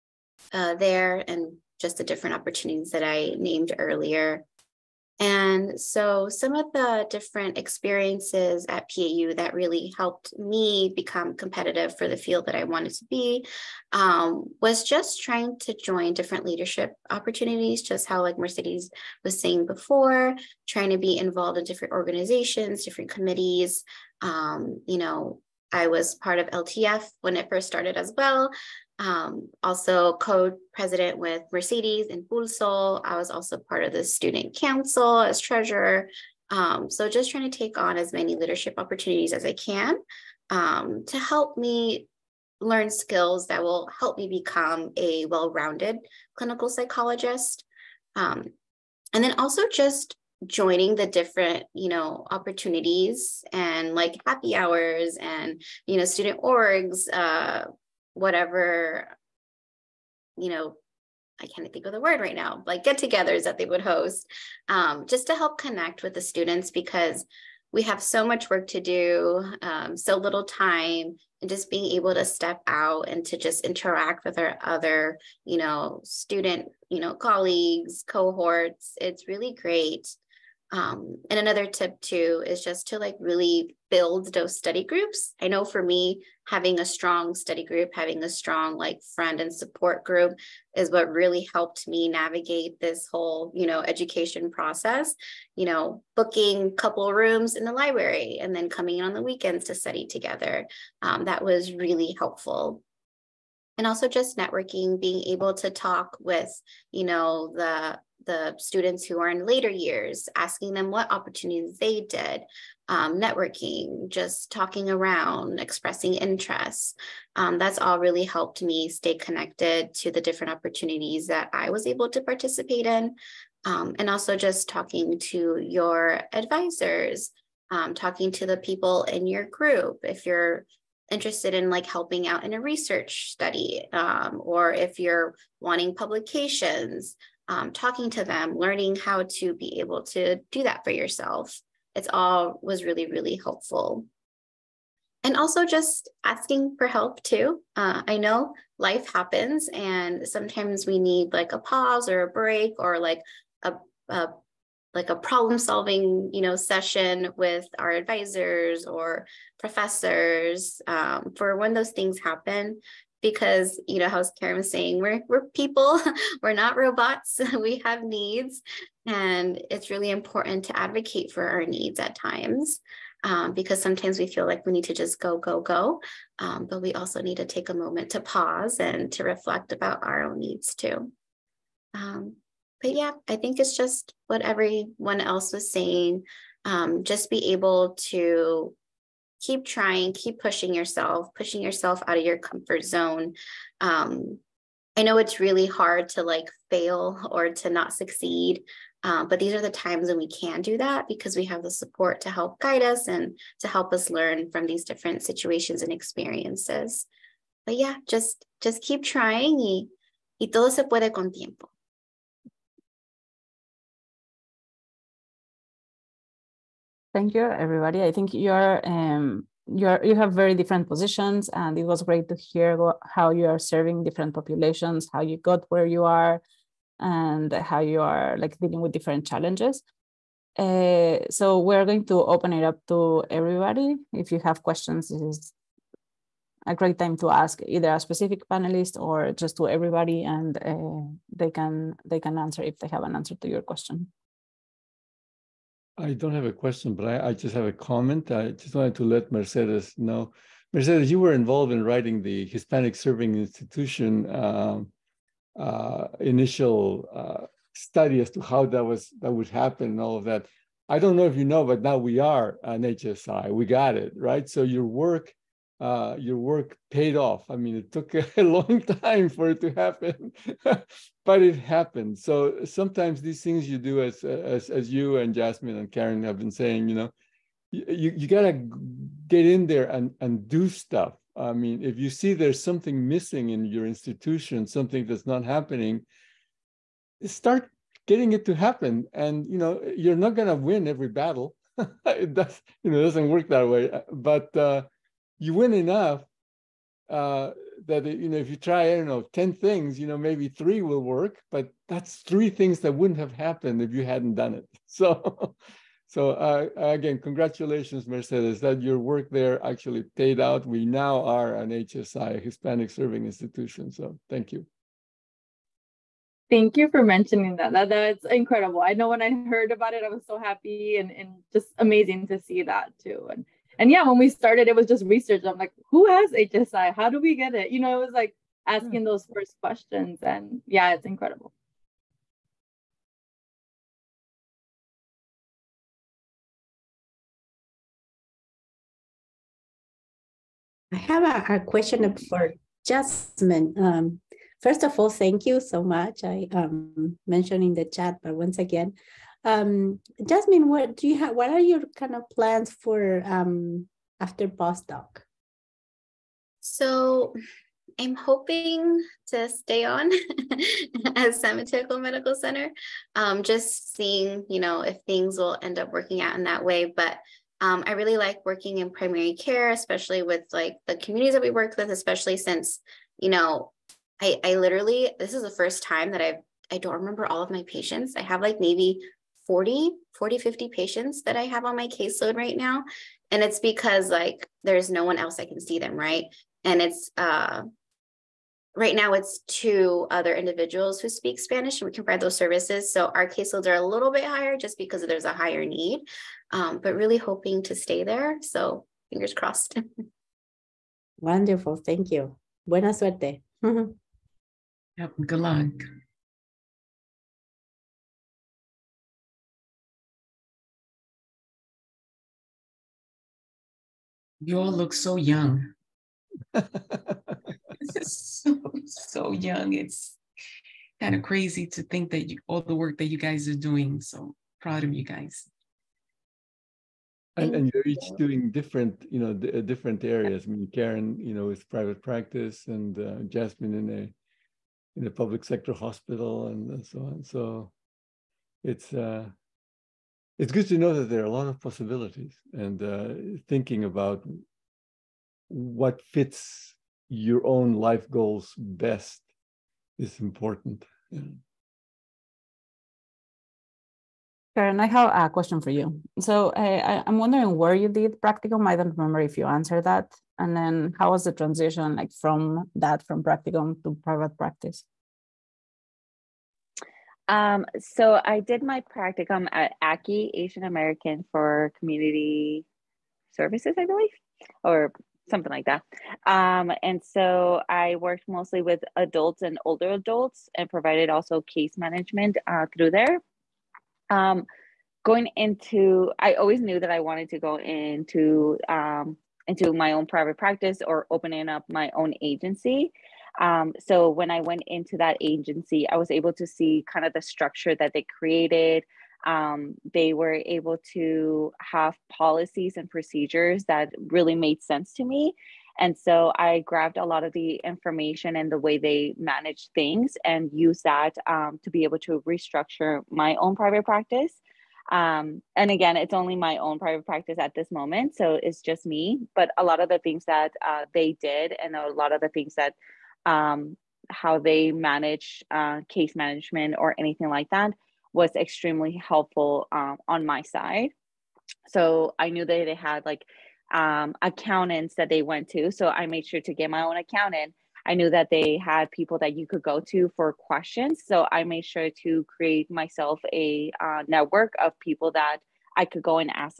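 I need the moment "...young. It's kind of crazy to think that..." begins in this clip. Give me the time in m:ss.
6:59.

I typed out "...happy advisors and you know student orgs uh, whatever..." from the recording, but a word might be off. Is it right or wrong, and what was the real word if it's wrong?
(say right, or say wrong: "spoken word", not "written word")
wrong: "hours", not "advisors".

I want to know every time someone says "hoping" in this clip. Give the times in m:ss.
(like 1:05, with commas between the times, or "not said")
5:58, 6:37.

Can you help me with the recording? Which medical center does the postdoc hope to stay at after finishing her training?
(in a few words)
San Medical Center.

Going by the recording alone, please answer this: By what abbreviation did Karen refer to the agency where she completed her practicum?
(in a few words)
ACI.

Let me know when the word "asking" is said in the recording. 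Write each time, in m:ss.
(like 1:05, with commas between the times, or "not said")
1:50, 2:26, 5:28.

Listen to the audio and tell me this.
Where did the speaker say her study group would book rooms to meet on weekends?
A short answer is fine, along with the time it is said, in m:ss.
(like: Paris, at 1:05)
The library, at 1:37.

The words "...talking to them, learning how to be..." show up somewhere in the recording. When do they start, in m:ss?
2:17.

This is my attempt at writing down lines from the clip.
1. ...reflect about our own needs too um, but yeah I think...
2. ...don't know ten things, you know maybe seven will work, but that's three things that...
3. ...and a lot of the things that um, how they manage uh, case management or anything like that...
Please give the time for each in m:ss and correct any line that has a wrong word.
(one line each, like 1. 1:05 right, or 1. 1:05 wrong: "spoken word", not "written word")
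1. 2:59 right
2. 4:58 wrong: "three", not "seven"
3. 8:41 right.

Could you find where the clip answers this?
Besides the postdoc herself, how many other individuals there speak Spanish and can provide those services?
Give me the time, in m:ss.
6:29.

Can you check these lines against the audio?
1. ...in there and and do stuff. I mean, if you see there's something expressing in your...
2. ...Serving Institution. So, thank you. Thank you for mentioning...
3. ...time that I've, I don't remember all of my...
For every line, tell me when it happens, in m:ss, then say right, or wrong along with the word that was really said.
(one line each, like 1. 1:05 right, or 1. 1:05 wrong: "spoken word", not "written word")
1. 4:39 wrong: "missing", not "expressing"
2. 5:12 right
3. 6:15 right.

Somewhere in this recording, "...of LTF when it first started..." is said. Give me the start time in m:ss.
0:26.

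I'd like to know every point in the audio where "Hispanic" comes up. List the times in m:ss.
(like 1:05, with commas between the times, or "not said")
4:12, 5:12.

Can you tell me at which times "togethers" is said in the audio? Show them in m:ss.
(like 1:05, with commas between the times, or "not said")
1:02, 1:40.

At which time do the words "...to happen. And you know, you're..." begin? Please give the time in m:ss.
4:48.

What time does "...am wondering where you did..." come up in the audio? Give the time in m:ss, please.
7:37.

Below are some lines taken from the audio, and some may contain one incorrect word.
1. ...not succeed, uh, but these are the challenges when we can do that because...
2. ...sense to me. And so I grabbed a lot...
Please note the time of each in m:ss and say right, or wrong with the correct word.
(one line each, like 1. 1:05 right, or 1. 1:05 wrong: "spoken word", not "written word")
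1. 3:17 wrong: "times", not "challenges"
2. 8:24 right.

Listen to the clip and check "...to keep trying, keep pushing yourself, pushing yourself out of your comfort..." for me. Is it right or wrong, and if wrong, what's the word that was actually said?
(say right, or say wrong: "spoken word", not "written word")
right.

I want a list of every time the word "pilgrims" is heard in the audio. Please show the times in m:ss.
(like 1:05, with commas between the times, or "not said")
not said.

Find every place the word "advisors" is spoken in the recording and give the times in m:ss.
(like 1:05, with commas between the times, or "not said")
2:06, 2:37.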